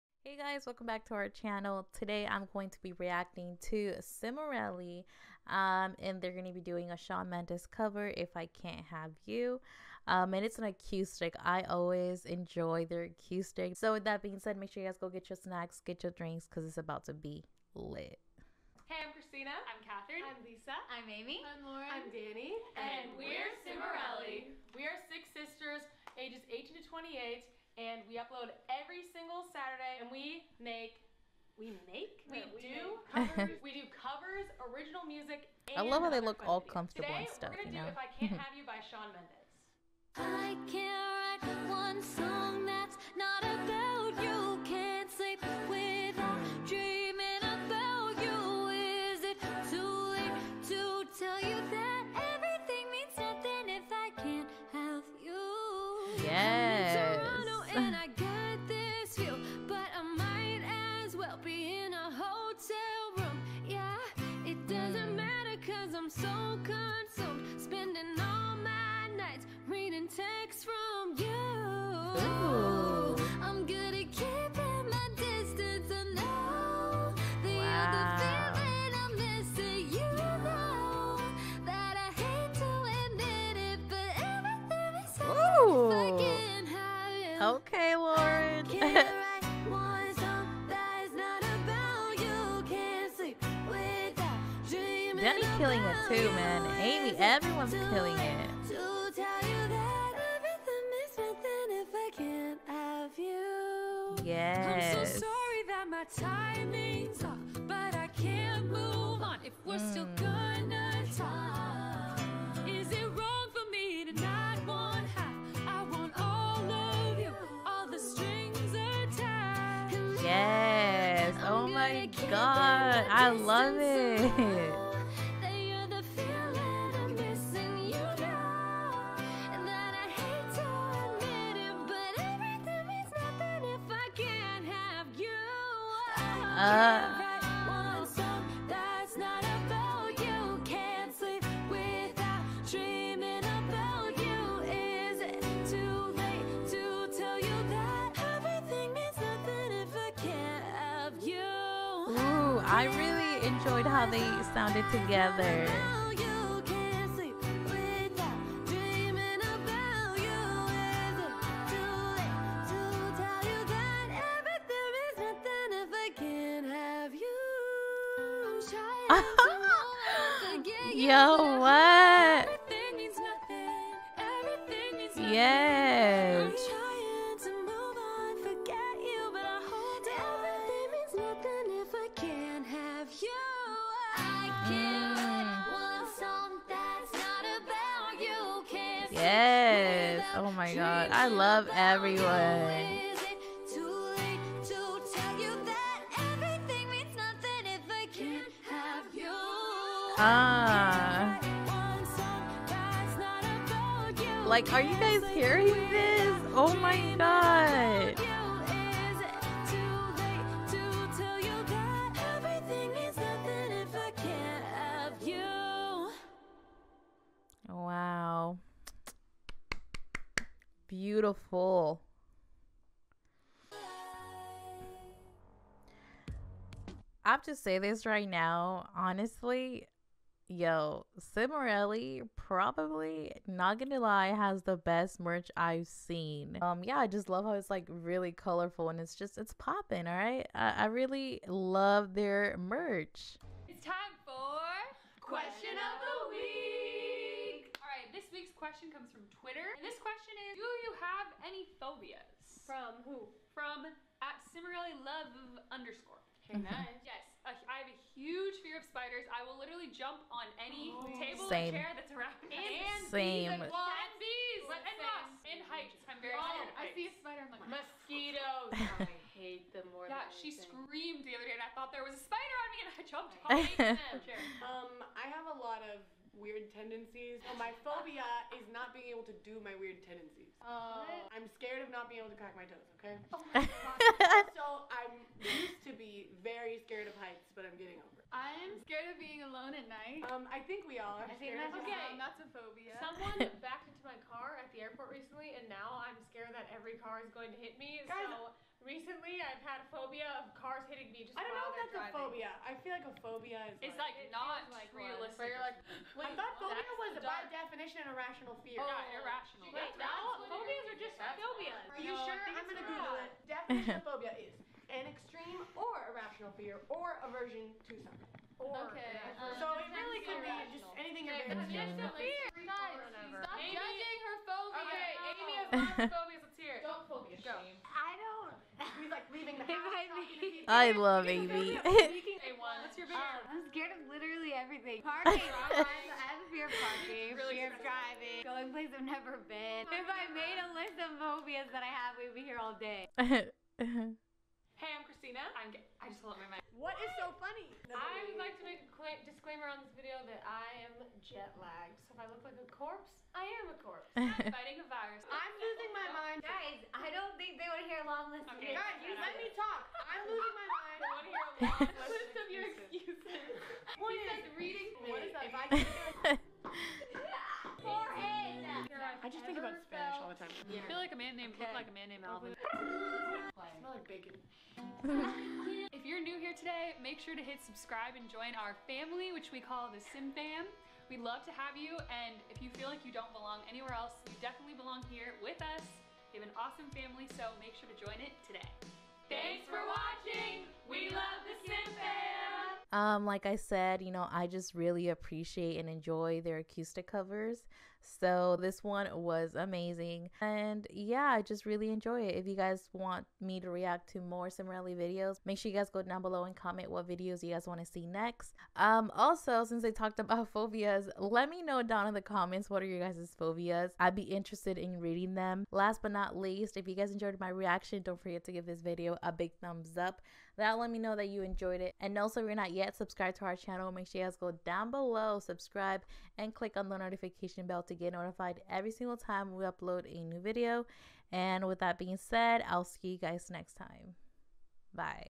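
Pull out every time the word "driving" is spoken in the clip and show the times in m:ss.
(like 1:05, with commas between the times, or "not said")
5:01, 5:37.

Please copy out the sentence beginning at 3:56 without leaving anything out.
Um, yeah, I just love how it's like really colorful and it's just it's popping.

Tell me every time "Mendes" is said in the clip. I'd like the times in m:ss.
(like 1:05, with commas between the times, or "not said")
0:07, 0:39.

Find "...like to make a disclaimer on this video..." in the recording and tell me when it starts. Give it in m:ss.
5:48.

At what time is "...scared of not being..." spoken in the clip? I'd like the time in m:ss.
4:41.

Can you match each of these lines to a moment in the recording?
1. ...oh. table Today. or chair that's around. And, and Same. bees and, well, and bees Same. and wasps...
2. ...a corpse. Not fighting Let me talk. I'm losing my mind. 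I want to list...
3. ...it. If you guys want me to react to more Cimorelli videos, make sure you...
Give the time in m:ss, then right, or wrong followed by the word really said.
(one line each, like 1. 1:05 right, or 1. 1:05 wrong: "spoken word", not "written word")
1. 4:20 wrong: "Same", not "Today"
2. 5:53 right
3. 6:42 right.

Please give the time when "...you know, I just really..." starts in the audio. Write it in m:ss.
6:34.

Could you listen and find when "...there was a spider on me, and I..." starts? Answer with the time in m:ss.
4:31.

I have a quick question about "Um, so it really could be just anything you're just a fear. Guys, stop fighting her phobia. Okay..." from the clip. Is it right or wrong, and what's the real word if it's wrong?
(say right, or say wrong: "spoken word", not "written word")
wrong: "judging", not "fighting".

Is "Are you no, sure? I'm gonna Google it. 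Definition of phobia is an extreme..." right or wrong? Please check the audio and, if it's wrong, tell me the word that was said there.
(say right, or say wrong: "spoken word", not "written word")
right.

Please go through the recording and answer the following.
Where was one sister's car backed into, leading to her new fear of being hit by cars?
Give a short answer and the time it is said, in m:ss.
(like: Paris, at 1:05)
The airport, at 4:54.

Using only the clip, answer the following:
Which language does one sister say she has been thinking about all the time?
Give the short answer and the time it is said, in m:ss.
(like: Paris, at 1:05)
Spanish, at 6:09.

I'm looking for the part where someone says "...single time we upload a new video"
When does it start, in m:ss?
7:08.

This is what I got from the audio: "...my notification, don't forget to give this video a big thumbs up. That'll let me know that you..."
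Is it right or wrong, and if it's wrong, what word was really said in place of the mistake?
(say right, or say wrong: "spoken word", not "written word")
wrong: "reaction", not "notification".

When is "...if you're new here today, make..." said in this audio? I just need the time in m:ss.
6:15.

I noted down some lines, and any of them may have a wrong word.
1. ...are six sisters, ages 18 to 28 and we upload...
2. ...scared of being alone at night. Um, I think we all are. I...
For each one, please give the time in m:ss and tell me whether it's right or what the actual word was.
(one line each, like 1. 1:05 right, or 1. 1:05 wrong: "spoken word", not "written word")
1. 0:24 right
2. 4:48 right.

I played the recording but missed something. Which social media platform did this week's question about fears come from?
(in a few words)
Twitter.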